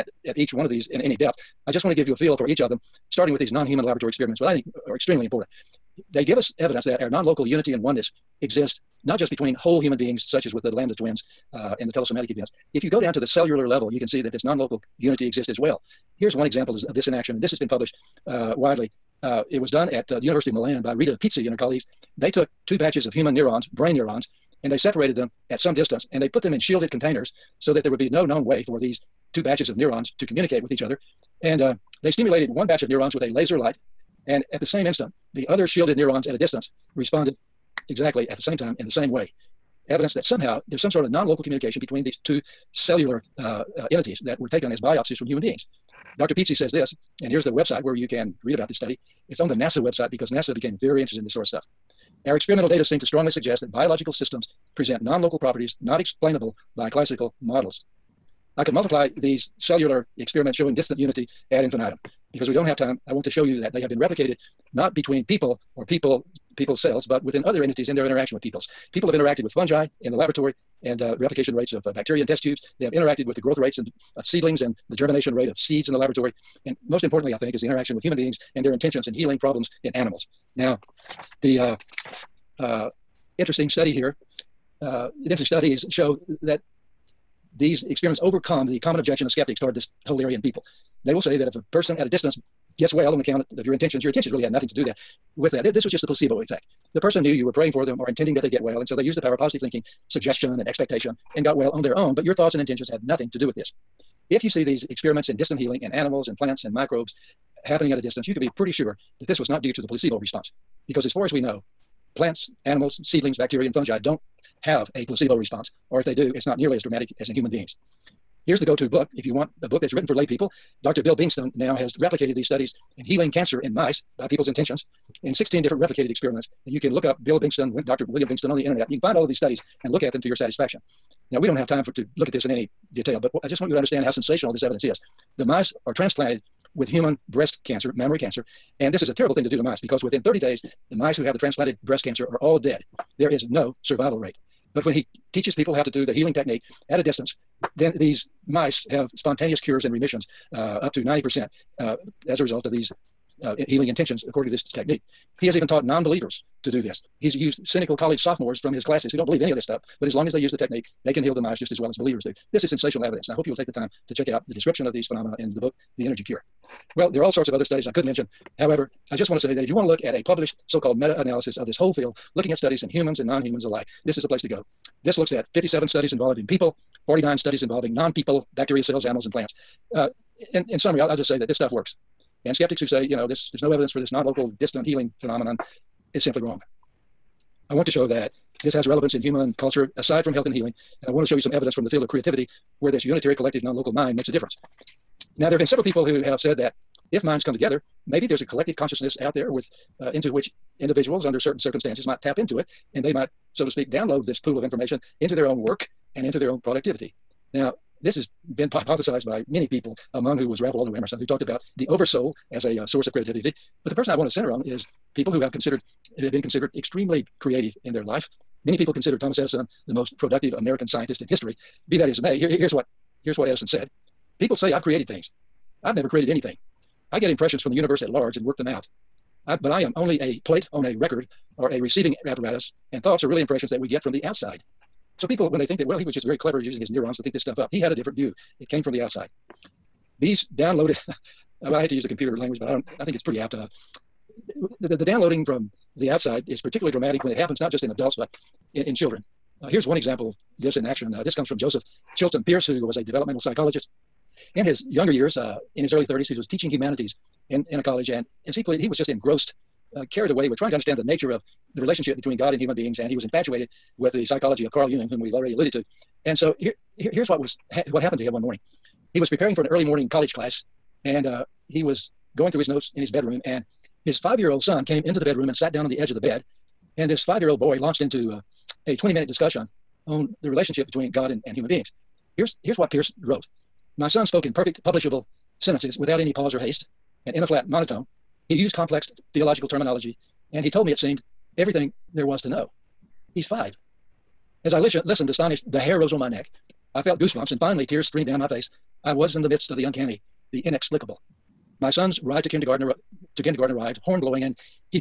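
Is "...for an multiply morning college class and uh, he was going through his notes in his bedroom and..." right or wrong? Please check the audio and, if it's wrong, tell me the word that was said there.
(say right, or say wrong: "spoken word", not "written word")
wrong: "early", not "multiply".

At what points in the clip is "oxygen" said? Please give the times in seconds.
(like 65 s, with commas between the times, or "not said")
not said.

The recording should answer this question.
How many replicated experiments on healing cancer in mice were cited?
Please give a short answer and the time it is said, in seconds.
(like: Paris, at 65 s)
16, at 125 s.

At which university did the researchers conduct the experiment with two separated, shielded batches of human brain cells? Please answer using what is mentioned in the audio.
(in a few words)
University of Milan.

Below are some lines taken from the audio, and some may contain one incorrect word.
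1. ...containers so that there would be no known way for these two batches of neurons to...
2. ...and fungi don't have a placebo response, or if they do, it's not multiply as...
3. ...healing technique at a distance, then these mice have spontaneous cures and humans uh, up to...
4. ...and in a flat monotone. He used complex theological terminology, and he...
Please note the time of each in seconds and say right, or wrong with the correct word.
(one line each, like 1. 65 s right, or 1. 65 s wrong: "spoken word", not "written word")
1. 26 s right
2. 113 s wrong: "nearly", not "multiply"
3. 146 s wrong: "remissions", not "humans"
4. 287 s right.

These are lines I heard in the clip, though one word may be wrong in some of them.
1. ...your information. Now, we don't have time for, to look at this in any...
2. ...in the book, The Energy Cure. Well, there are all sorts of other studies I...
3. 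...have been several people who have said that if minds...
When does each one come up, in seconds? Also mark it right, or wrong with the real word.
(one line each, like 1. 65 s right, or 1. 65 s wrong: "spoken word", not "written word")
1. 130 s wrong: "satisfaction", not "information"
2. 165 s right
3. 195 s right.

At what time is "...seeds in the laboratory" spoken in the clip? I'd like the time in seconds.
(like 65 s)
75 s.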